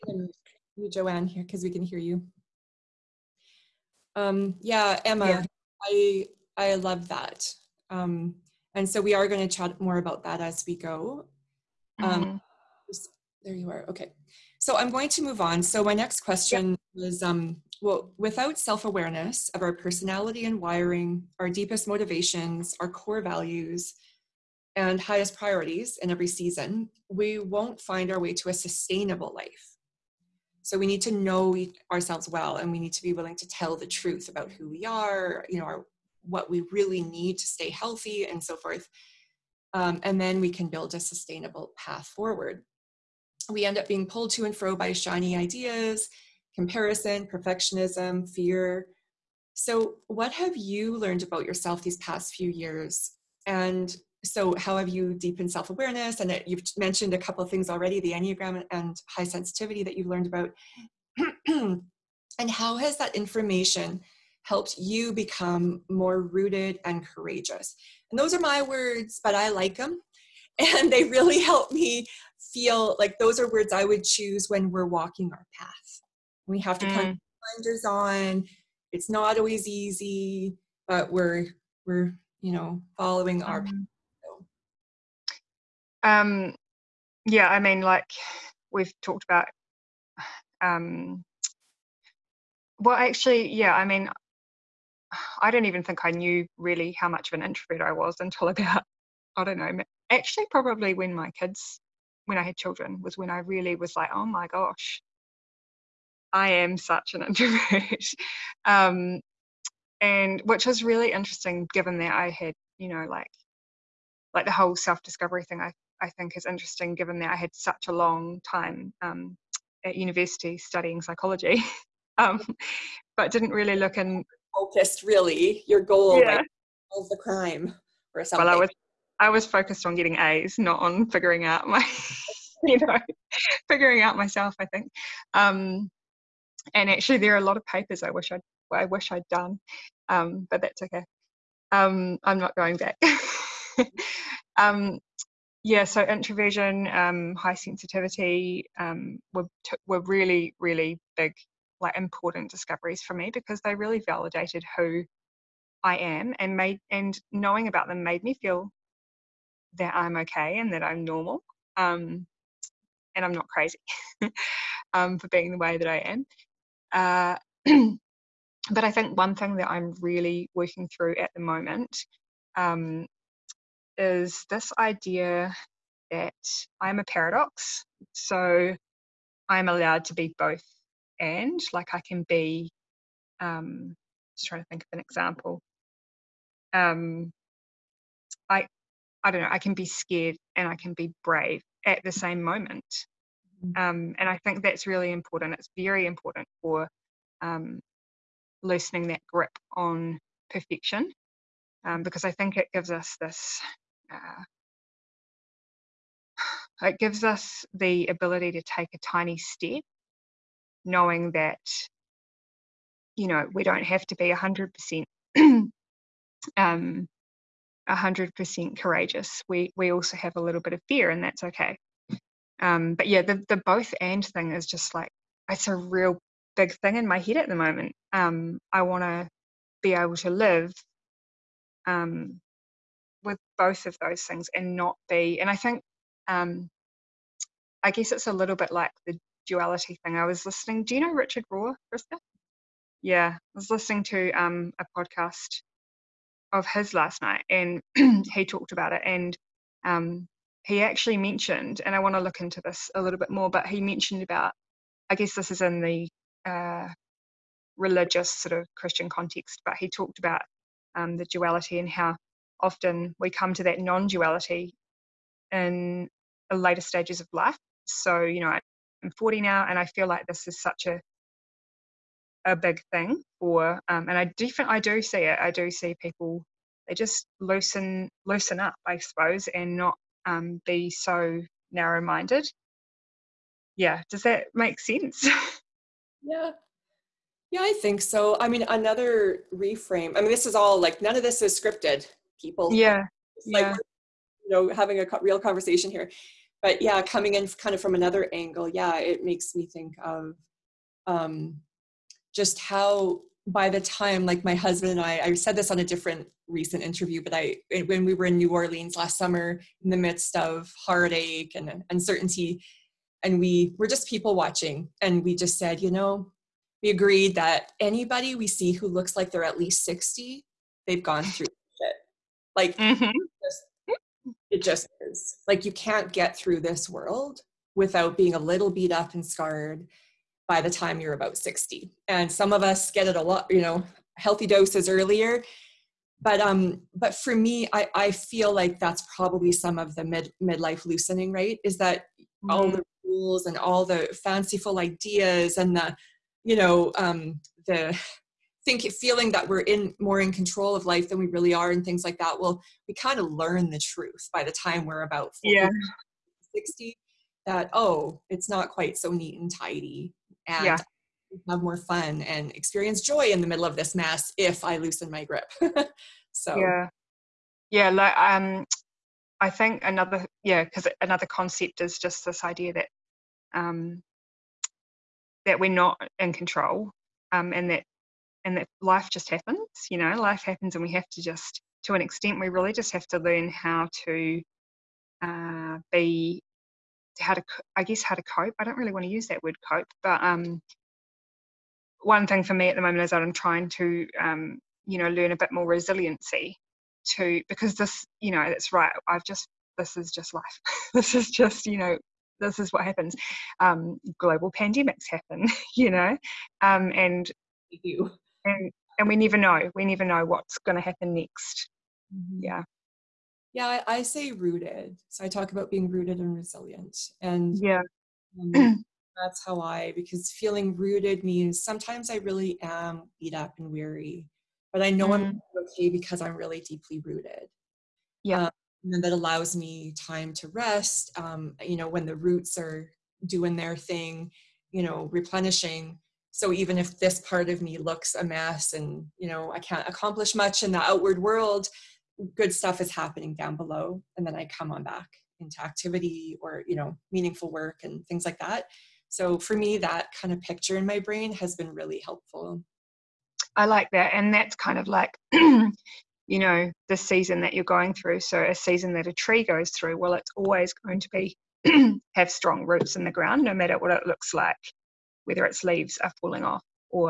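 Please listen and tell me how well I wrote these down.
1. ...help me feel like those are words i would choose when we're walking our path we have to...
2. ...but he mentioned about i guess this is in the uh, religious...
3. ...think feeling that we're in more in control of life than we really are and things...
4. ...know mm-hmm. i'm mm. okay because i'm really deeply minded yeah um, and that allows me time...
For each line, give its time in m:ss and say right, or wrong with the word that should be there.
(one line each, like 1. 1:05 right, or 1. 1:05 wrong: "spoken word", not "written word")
1. 1:11 right
2. 4:13 right
3. 5:48 right
4. 7:04 wrong: "rooted", not "minded".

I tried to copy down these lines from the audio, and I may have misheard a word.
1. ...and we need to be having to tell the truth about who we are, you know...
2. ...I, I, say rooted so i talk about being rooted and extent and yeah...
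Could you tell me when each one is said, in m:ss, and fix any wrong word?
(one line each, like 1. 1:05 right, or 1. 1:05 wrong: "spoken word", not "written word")
1. 0:32 wrong: "willing", not "having"
2. 6:53 wrong: "resilient", not "extent".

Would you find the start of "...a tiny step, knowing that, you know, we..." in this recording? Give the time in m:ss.
3:28.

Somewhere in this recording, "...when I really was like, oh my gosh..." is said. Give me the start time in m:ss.
1:43.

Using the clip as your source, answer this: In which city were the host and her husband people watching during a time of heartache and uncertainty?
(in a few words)
New Orleans.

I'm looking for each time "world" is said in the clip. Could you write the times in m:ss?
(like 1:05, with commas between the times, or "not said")
5:26, 7:21.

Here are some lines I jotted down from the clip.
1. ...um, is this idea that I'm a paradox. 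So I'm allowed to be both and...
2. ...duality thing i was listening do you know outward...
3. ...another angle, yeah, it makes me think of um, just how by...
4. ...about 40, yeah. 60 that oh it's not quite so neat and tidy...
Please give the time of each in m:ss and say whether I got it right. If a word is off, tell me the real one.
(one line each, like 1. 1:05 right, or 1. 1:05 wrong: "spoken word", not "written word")
1. 2:52 right
2. 3:59 wrong: "richard", not "outward"
3. 4:57 right
4. 5:55 right.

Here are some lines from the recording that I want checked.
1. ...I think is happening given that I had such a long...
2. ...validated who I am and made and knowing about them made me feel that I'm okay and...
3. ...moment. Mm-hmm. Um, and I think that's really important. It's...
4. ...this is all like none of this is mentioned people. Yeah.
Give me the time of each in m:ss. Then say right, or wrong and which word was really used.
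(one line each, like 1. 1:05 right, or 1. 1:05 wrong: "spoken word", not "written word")
1. 1:56 wrong: "interesting", not "happening"
2. 2:34 right
3. 3:12 right
4. 4:50 wrong: "scripted", not "mentioned".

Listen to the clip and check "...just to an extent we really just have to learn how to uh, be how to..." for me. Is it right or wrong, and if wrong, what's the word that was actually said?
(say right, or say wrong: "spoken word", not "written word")
right.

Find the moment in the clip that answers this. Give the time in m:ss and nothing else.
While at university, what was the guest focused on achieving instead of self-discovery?
2:09.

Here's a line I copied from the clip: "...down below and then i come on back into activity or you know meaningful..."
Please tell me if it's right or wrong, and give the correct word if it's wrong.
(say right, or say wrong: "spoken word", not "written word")
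right.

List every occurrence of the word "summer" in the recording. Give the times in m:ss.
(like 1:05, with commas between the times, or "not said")
5:09.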